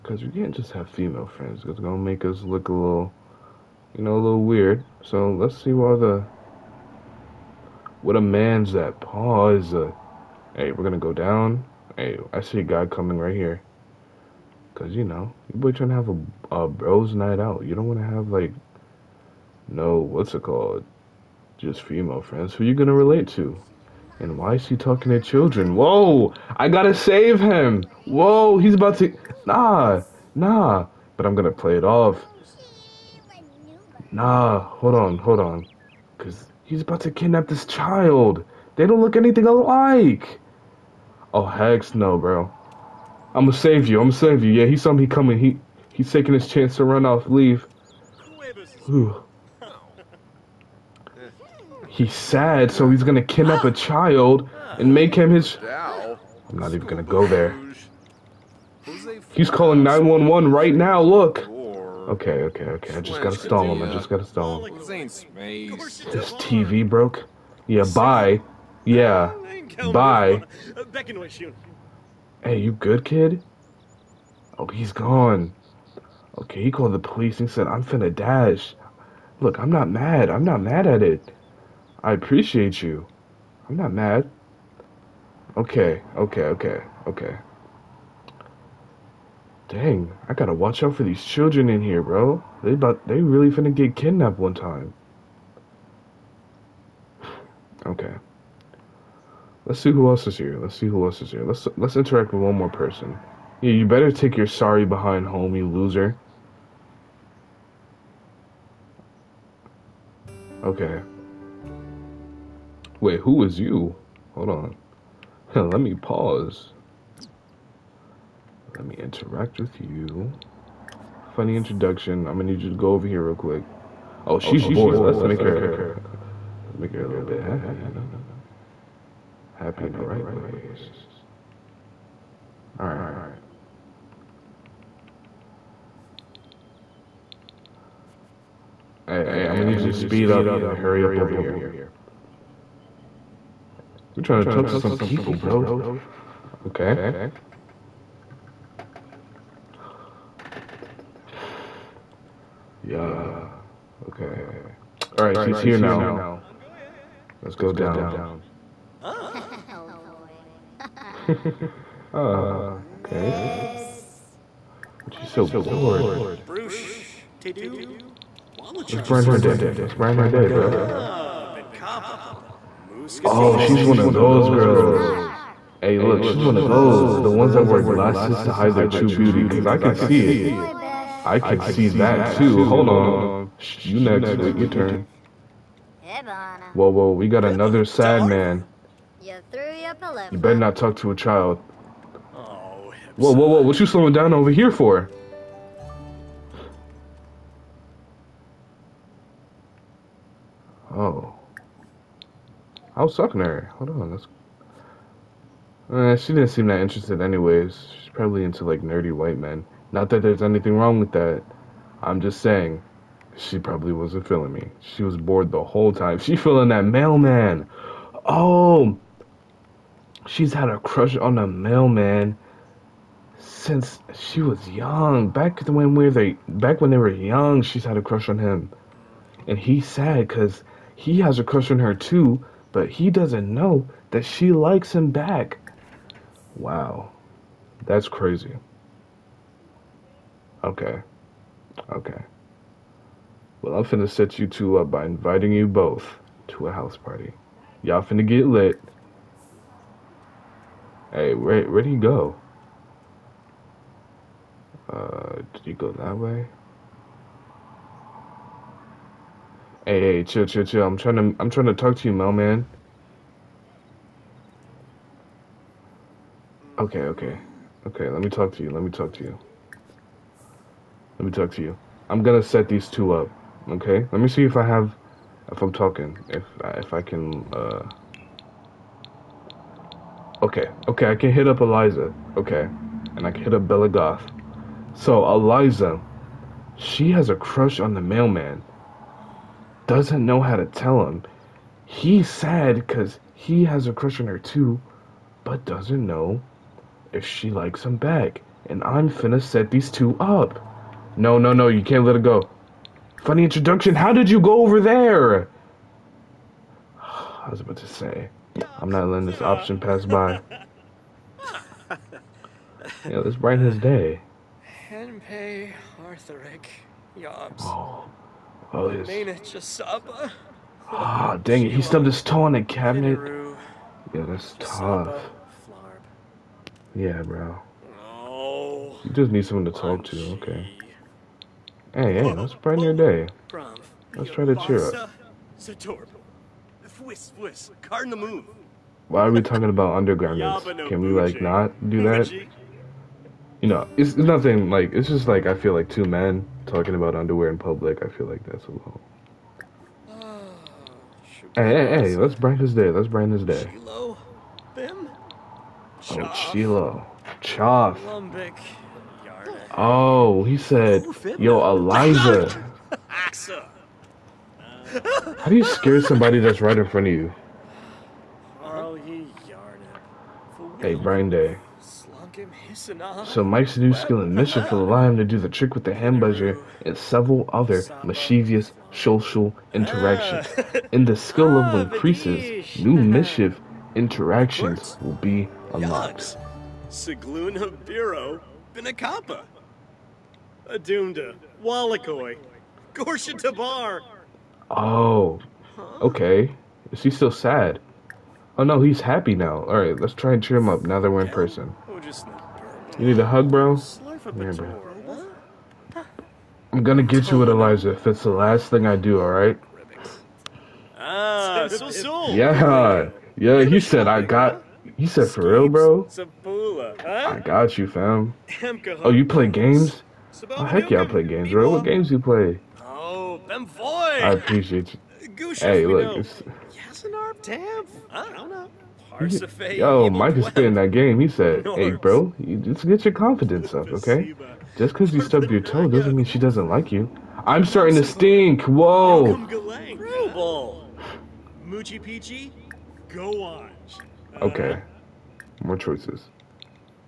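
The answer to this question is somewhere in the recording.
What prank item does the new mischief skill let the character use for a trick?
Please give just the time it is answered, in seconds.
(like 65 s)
375 s.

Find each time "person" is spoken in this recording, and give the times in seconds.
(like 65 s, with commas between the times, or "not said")
102 s, 401 s.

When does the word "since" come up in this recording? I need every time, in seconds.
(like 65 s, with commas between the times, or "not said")
223 s.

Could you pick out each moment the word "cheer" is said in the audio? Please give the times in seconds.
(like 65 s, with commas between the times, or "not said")
334 s, 400 s.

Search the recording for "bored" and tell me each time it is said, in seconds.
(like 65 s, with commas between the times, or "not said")
124 s, 165 s, 215 s.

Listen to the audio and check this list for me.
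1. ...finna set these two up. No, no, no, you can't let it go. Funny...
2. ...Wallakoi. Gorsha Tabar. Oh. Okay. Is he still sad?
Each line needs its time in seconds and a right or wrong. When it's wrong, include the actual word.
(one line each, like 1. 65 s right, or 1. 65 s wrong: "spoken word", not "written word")
1. 299 s right
2. 391 s right.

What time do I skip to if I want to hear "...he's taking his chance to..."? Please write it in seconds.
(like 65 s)
45 s.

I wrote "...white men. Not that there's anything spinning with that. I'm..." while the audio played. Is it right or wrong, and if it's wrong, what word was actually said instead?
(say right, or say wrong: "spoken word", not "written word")
wrong: "wrong", not "spinning".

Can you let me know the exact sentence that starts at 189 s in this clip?
You better not talk to a child.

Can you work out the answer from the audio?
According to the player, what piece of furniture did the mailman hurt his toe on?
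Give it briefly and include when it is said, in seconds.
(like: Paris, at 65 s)
The cabinet, at 322 s.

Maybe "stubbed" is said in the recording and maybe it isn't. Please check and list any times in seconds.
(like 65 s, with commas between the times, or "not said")
321 s, 435 s.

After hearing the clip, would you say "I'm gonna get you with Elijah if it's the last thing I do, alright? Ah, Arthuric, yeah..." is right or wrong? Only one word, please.
wrong.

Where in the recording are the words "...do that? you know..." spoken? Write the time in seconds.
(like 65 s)
341 s.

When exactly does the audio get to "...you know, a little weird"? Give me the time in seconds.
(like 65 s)
3 s.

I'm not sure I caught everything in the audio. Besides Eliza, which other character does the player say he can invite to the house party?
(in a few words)
Bella Goth.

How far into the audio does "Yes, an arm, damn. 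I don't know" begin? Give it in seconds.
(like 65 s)
426 s.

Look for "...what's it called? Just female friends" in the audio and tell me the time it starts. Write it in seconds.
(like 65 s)
19 s.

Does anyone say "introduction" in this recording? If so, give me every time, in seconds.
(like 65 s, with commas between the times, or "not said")
121 s, 303 s.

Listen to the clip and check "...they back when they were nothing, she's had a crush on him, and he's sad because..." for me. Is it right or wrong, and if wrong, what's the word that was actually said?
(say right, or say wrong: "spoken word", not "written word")
wrong: "young", not "nothing".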